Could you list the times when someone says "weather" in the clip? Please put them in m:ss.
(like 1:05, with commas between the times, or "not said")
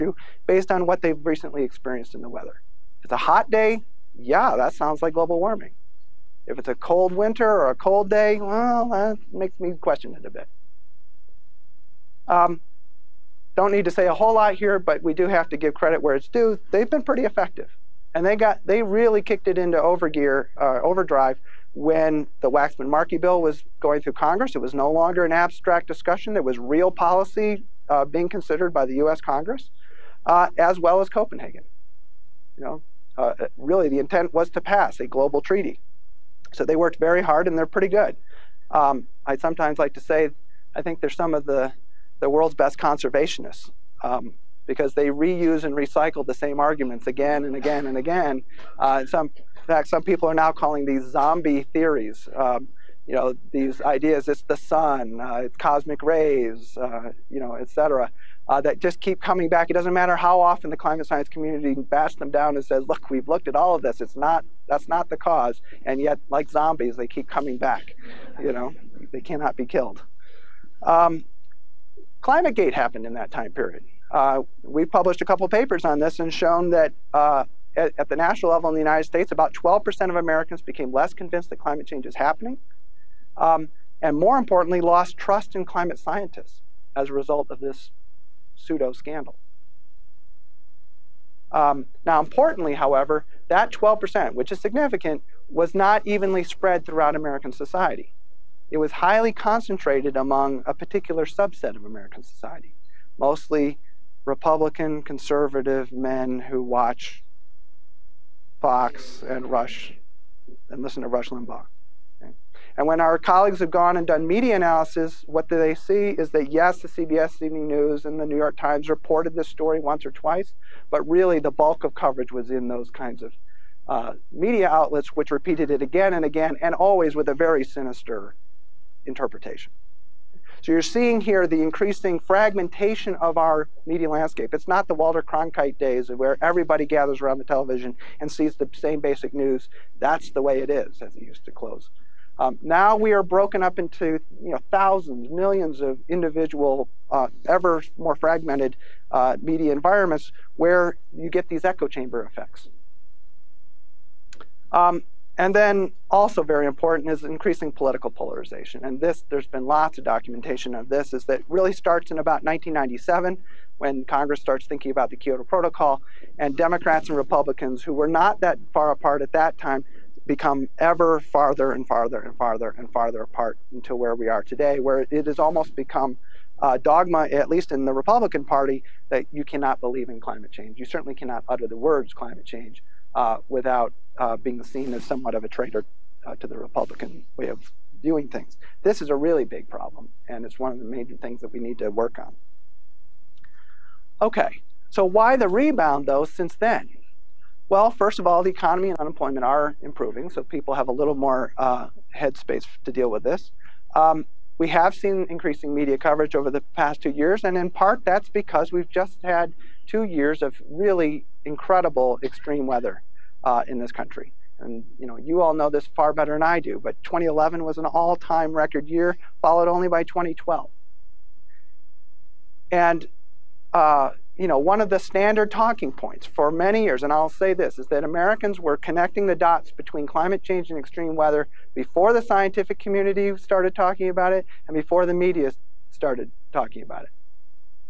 0:02, 3:32, 3:51.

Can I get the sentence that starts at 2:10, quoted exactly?
So you're seeing here the increasing fragmentation of our media landscape.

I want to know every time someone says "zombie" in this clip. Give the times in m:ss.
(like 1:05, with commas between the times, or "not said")
0:51, 1:06.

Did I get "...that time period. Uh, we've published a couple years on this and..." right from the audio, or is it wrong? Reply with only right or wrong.
wrong.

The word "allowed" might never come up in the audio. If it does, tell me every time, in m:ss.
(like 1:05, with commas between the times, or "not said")
not said.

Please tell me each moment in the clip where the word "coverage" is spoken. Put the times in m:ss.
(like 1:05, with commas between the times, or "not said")
2:01, 3:25.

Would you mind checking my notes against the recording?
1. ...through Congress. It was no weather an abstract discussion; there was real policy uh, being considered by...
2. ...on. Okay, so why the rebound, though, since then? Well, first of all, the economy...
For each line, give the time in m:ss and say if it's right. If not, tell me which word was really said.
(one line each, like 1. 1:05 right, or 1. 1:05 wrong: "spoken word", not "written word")
1. 0:24 wrong: "longer", not "weather"
2. 3:12 right.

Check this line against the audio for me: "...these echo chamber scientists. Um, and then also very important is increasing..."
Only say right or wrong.
wrong.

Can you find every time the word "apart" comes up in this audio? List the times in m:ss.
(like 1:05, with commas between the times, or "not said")
2:48, 2:53.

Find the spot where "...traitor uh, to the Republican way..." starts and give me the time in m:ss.
3:05.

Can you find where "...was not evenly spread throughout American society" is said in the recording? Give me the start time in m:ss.
1:35.